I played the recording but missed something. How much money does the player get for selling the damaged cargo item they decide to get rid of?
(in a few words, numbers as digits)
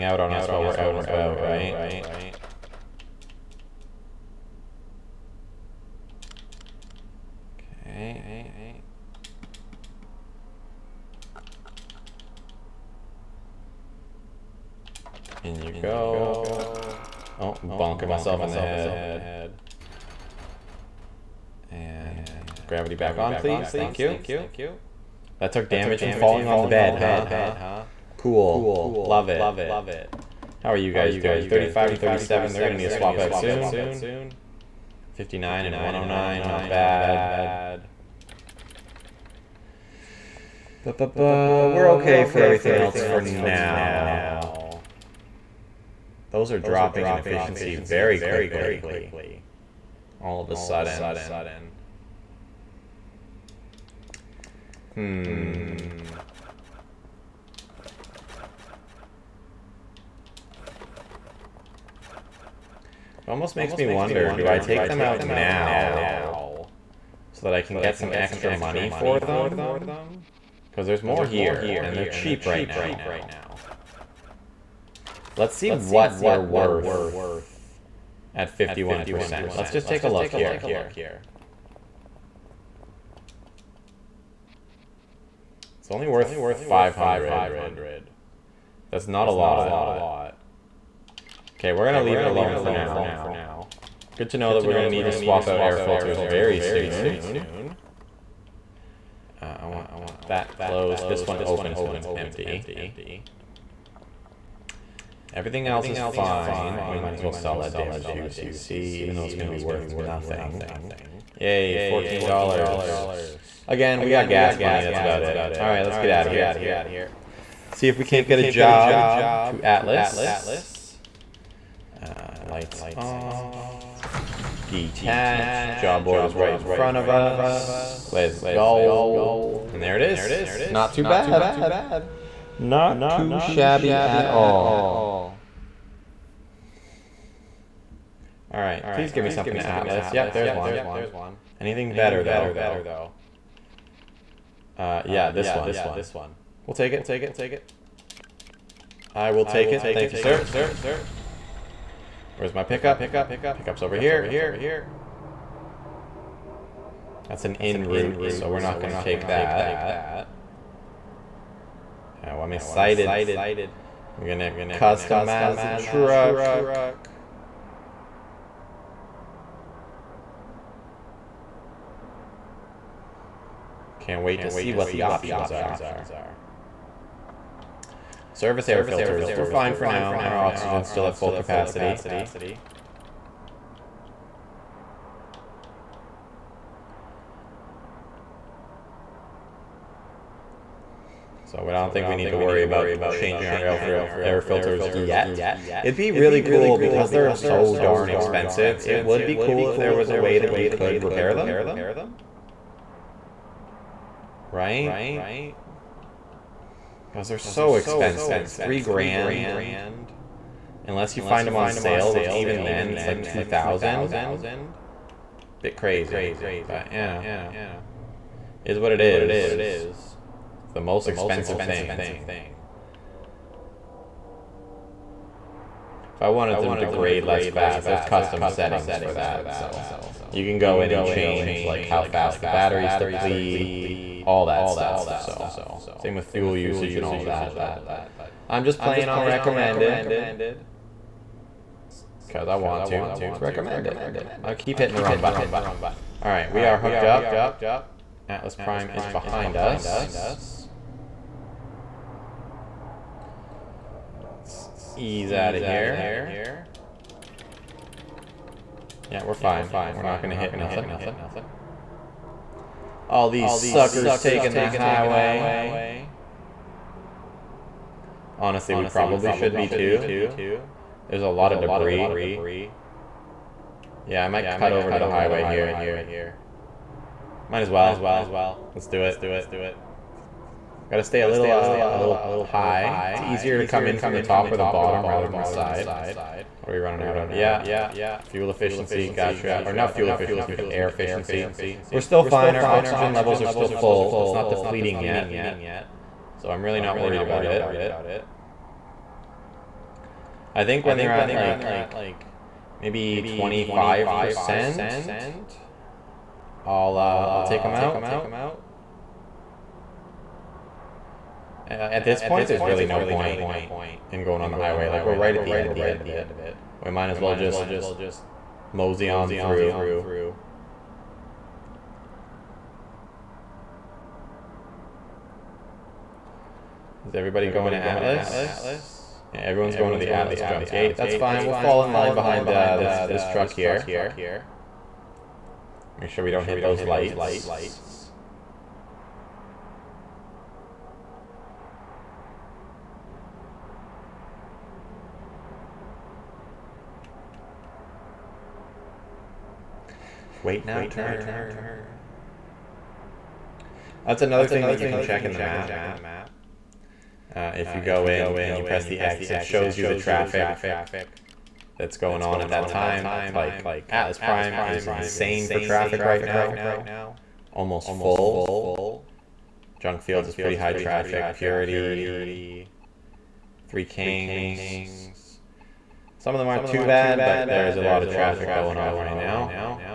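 $14.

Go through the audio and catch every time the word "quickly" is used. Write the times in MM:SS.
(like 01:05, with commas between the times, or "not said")
00:48.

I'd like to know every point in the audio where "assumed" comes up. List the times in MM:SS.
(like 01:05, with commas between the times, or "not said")
not said.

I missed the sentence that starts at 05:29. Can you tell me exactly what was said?
Yeah, everyone's going to the Atlas jump gate.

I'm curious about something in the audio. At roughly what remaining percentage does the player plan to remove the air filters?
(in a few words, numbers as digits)
25%.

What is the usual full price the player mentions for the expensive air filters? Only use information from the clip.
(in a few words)
3 grand.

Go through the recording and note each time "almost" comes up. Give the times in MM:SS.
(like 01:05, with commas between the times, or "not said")
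01:03, 06:07.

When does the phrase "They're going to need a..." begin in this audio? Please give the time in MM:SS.
00:32.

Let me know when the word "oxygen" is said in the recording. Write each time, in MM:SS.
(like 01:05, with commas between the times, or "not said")
03:00, 04:52.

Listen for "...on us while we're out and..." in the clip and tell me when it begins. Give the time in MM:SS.
00:00.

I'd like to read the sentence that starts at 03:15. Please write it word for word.
It'd be really cool because they're so darn expensive.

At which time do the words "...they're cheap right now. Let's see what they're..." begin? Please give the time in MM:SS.
01:11.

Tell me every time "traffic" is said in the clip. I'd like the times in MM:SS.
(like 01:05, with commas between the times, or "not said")
05:59, 06:05, 06:10, 06:18.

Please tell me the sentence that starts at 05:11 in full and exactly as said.
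At this point, there's really no point in going on the highway.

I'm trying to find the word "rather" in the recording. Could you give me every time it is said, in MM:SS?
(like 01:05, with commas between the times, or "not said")
04:45.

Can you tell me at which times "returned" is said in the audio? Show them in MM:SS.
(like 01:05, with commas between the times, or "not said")
not said.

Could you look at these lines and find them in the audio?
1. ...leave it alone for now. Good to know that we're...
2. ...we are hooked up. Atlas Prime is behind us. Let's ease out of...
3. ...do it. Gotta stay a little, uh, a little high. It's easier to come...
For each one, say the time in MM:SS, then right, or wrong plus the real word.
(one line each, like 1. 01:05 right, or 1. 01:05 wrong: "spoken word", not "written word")
1. 01:32 right
2. 04:06 right
3. 04:38 right.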